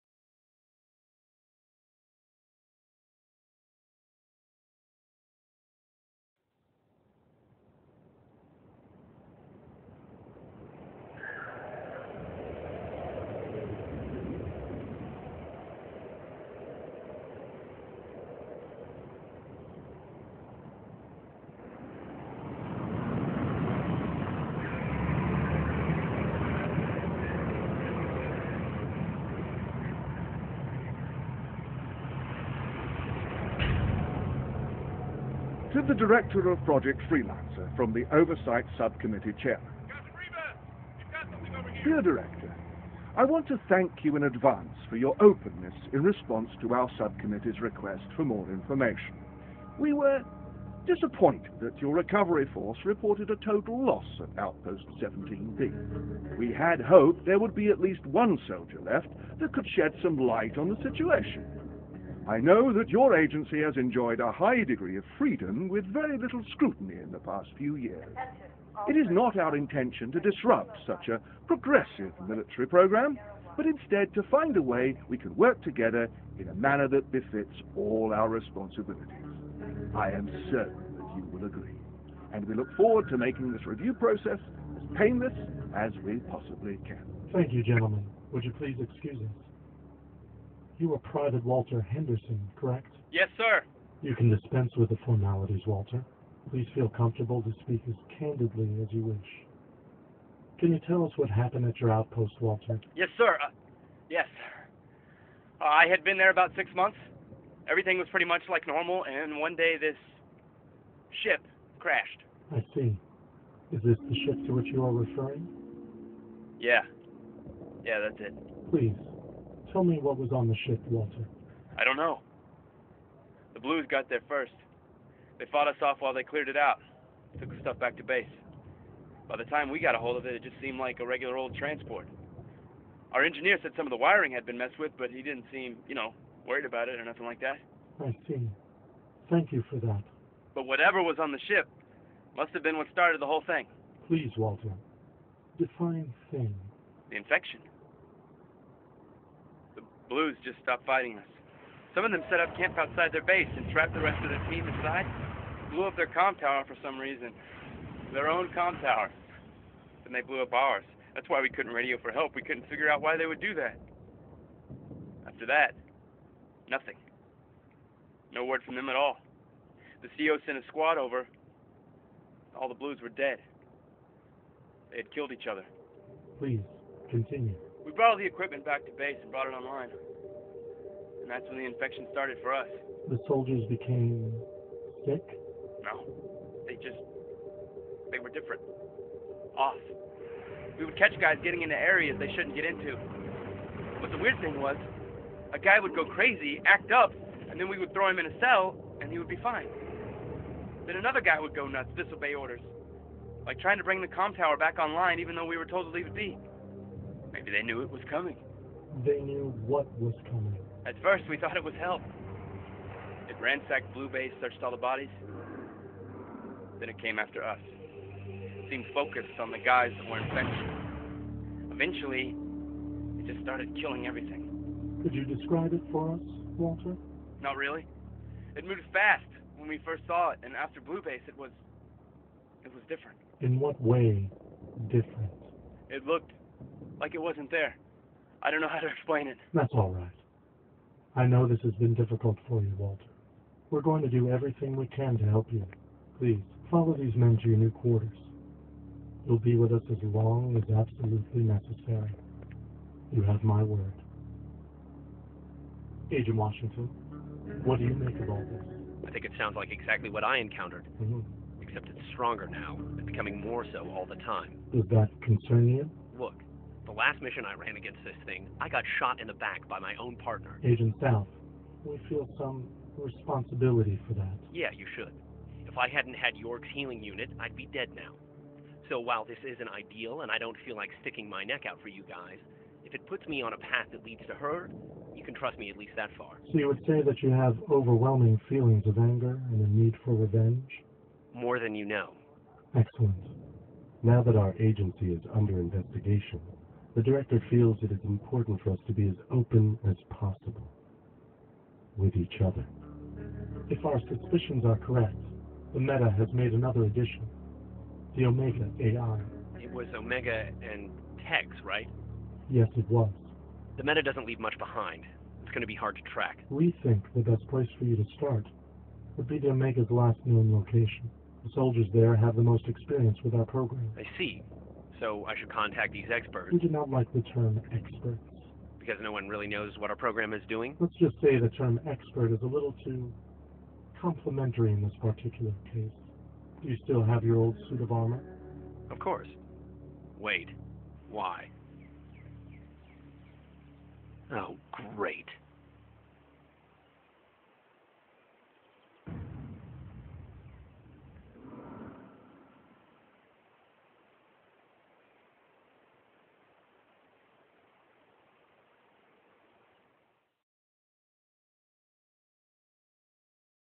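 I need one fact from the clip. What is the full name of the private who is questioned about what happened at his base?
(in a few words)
Walter Henderson.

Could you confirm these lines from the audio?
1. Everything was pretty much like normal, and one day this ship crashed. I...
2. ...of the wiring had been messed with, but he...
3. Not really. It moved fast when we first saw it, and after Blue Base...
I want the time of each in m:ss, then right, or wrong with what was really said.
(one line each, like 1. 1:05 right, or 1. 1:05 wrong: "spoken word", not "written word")
1. 1:47 right
2. 2:13 right
3. 3:47 right.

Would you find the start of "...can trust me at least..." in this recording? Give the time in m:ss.
4:45.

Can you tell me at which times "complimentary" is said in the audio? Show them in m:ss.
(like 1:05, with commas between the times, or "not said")
5:33.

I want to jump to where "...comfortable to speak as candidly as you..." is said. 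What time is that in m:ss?
1:36.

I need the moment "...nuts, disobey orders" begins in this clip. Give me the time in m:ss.
3:21.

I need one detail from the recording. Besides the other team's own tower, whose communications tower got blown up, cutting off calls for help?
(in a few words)
Ours.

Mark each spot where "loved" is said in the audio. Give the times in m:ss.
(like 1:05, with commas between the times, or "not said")
not said.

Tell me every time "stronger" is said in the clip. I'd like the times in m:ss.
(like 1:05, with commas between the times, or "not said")
4:22.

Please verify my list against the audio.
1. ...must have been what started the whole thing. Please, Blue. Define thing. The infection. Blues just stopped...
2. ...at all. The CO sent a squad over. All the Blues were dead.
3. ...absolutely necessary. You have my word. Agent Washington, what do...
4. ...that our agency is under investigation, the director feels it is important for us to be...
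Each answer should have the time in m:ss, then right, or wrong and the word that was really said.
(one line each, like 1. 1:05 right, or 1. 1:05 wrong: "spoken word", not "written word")
1. 2:22 wrong: "Walter", not "Blue"
2. 2:48 right
3. 4:10 right
4. 4:54 right.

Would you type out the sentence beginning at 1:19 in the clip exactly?
I am certain that you will agree, and we look forward to making this review process as painless as we possibly can.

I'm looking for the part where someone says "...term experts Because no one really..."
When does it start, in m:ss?
5:27.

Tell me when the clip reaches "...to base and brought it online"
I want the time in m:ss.
2:58.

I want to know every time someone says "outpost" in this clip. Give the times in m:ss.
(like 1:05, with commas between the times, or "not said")
0:54, 1:41.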